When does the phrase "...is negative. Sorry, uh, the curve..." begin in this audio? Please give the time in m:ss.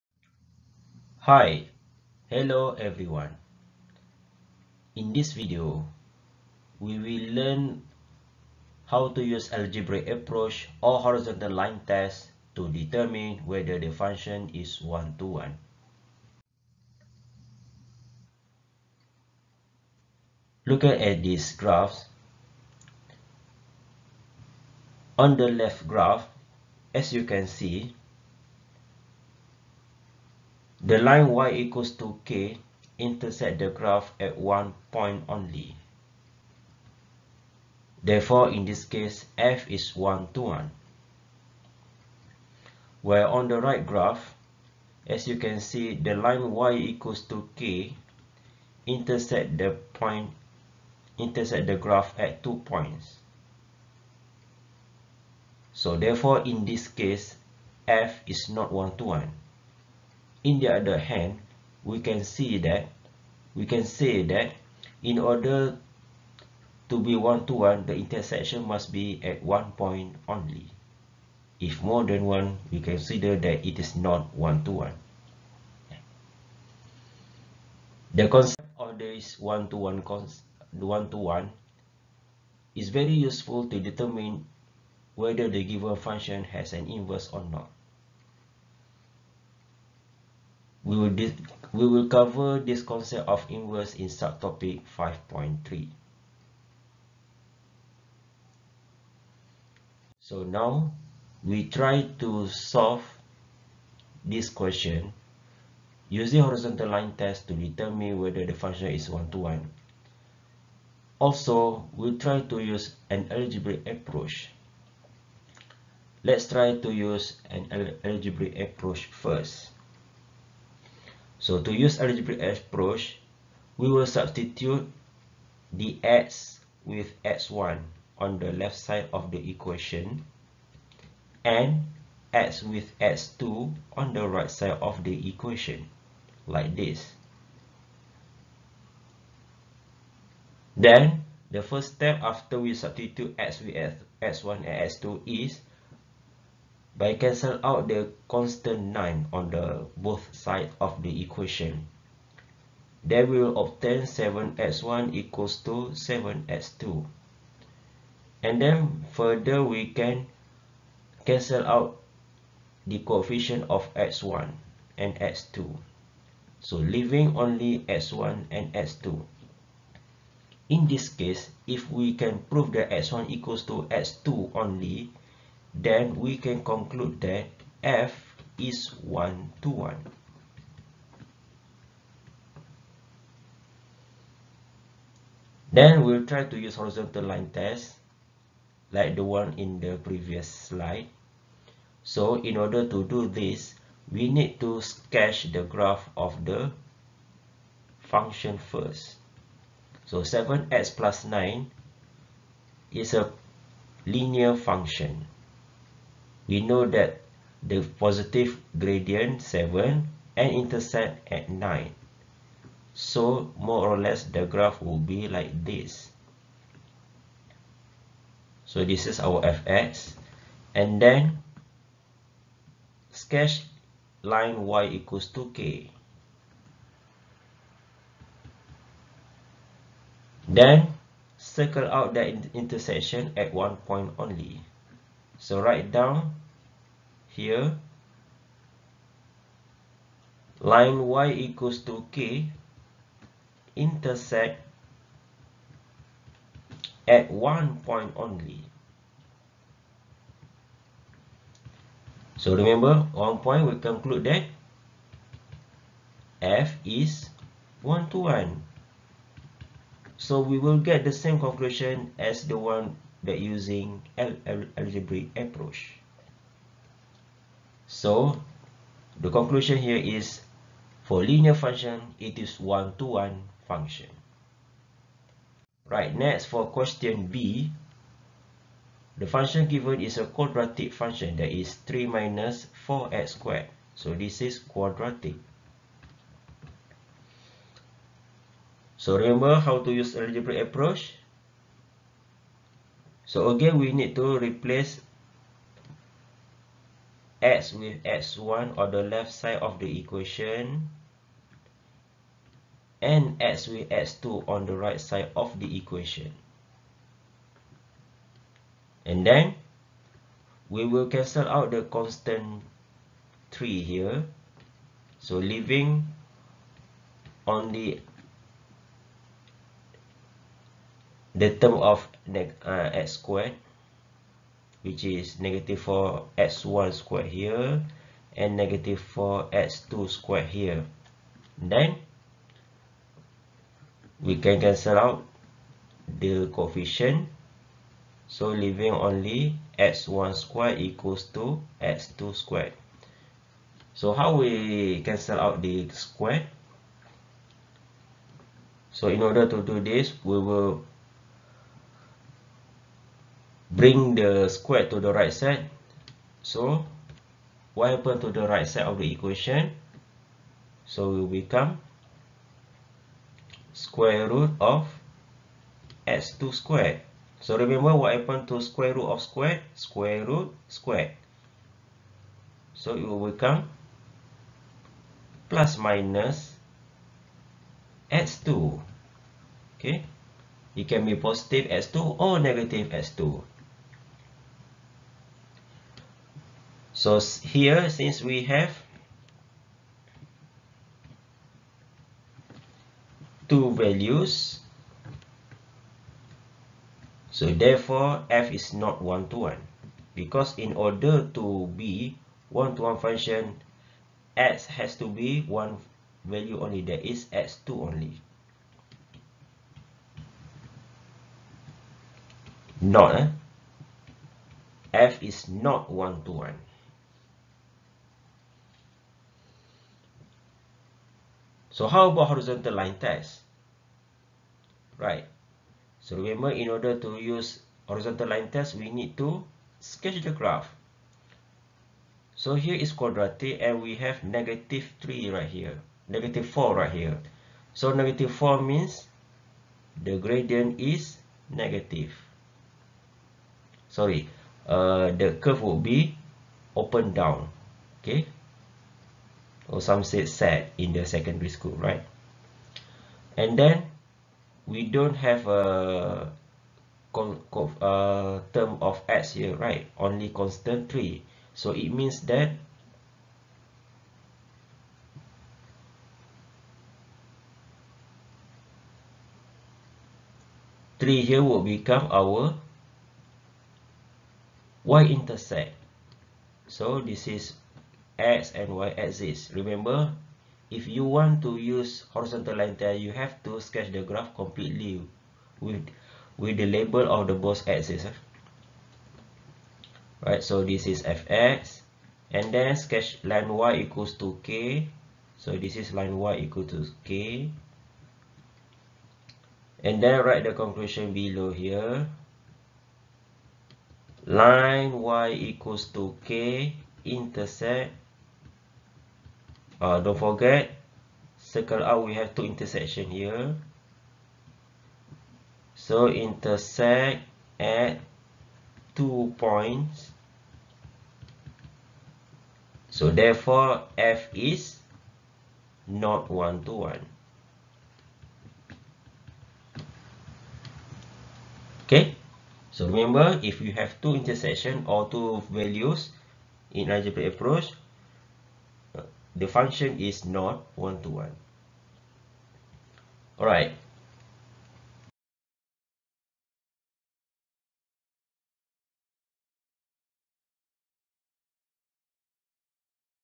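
7:20.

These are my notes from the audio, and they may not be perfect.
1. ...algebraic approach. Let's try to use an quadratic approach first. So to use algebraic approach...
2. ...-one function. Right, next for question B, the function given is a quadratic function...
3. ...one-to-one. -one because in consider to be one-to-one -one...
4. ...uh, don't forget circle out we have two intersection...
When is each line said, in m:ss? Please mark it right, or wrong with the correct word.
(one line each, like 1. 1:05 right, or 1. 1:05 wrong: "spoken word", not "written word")
1. 1:53 wrong: "algebraic", not "quadratic"
2. 4:33 right
3. 6:39 wrong: "order", not "consider"
4. 8:29 right.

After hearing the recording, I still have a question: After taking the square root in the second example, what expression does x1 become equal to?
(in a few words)
plus minus x2.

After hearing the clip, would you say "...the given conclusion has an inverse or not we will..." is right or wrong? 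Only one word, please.
wrong.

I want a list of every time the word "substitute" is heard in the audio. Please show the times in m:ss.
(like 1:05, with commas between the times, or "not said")
2:04, 2:22.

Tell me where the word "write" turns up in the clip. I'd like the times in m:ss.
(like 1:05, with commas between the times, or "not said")
3:55, 8:20.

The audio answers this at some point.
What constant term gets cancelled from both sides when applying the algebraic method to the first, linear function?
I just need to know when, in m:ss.
2:28.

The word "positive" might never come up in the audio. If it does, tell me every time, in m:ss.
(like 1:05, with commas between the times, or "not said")
3:27, 6:21.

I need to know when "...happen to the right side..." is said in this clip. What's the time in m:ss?
5:57.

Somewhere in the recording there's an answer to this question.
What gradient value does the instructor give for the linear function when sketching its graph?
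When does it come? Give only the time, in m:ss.
3:27.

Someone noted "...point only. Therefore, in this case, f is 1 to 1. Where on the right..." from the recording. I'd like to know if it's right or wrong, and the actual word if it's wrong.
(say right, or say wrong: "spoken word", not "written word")
right.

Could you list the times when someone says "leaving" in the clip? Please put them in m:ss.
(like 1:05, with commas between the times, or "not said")
2:46, 5:15, 5:38.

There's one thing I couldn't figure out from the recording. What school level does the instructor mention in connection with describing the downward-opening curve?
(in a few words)
secondary school.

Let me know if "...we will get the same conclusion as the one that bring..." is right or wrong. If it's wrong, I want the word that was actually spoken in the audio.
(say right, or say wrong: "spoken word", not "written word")
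wrong: "using", not "bring".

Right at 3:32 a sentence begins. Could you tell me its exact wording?
So more or less the graph will be like this.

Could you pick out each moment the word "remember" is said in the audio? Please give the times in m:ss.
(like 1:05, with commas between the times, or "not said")
4:12, 4:49, 6:07, 7:06, 7:59, 8:52.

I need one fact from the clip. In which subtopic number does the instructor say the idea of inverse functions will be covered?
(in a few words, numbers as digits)
5.3.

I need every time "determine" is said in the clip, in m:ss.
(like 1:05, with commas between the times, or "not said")
0:12, 1:23, 1:47.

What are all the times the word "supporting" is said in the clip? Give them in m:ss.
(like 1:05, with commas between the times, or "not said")
not said.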